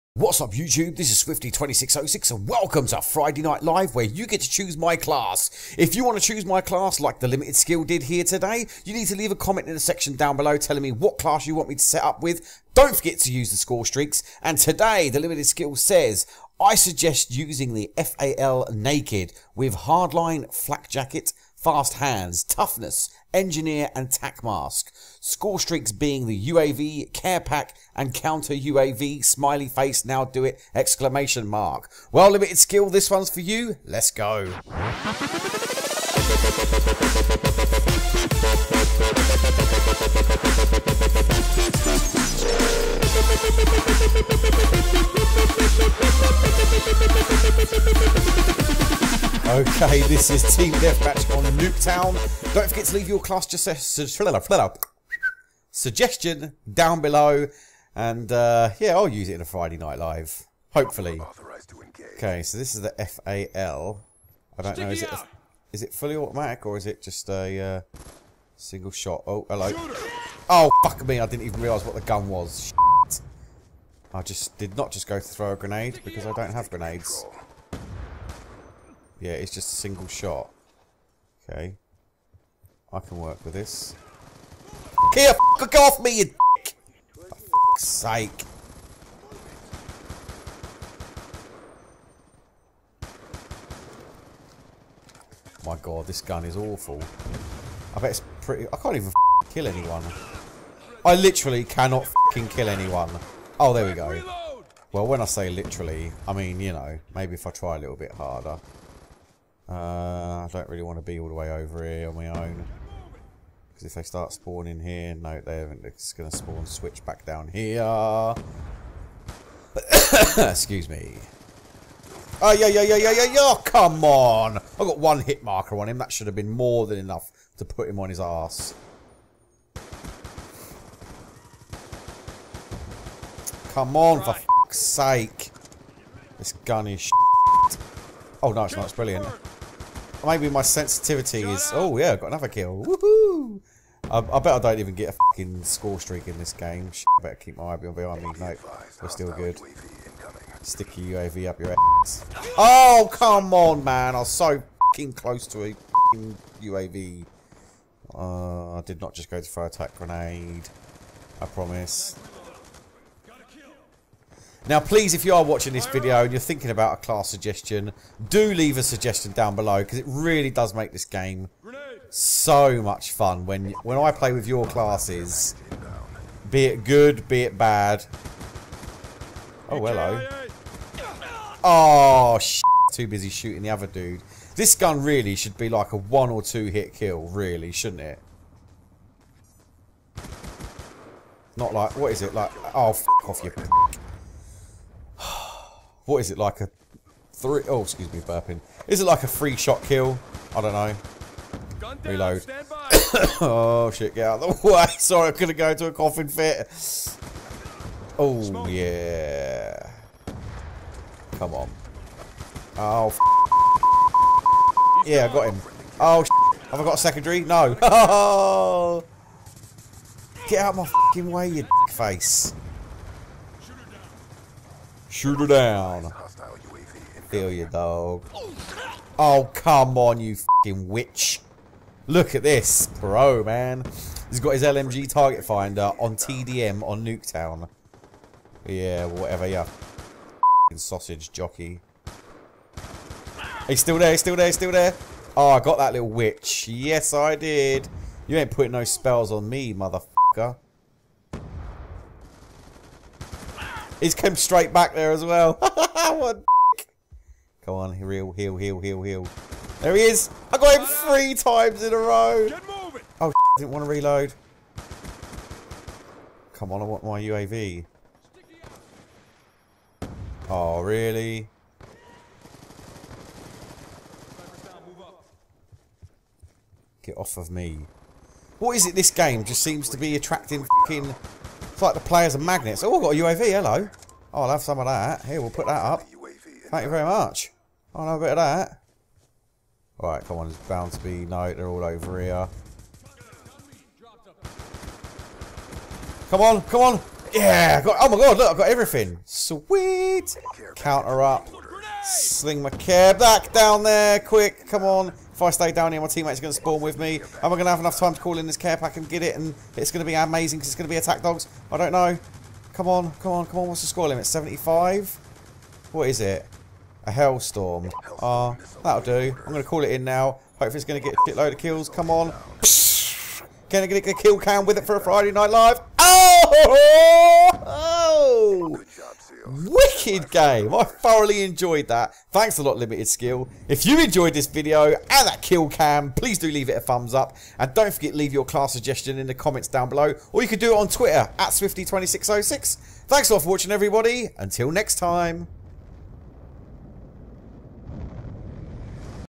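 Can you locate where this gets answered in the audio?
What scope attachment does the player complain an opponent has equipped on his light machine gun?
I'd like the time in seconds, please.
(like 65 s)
235 s.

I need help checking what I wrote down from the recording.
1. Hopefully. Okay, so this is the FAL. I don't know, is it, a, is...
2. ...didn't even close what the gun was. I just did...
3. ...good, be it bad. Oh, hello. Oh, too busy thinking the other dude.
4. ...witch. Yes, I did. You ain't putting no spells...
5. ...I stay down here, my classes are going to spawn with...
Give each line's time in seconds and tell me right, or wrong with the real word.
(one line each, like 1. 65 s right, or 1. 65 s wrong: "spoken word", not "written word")
1. 60 s right
2. 71 s wrong: "realise", not "close"
3. 176 s wrong: "shooting", not "thinking"
4. 246 s right
5. 305 s wrong: "teammates", not "classes".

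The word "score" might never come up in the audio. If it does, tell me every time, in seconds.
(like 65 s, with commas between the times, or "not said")
13 s, 25 s, 145 s, 313 s.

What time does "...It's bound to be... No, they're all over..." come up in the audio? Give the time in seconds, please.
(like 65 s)
290 s.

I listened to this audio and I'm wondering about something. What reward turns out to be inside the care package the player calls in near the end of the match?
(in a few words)
Hellstorm.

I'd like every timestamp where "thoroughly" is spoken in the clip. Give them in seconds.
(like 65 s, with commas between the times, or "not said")
330 s.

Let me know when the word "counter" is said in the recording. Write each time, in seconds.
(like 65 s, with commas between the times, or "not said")
28 s, 300 s.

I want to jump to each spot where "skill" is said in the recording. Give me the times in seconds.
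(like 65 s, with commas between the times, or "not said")
7 s, 15 s, 32 s, 333 s.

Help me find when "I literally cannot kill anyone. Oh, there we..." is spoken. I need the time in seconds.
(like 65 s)
101 s.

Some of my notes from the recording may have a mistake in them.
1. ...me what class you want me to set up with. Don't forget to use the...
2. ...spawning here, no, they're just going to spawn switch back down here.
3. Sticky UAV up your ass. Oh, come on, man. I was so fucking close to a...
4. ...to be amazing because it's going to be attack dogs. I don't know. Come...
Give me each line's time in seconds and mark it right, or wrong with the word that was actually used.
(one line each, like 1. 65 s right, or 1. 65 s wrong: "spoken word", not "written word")
1. 10 s right
2. 114 s right
3. 150 s right
4. 310 s right.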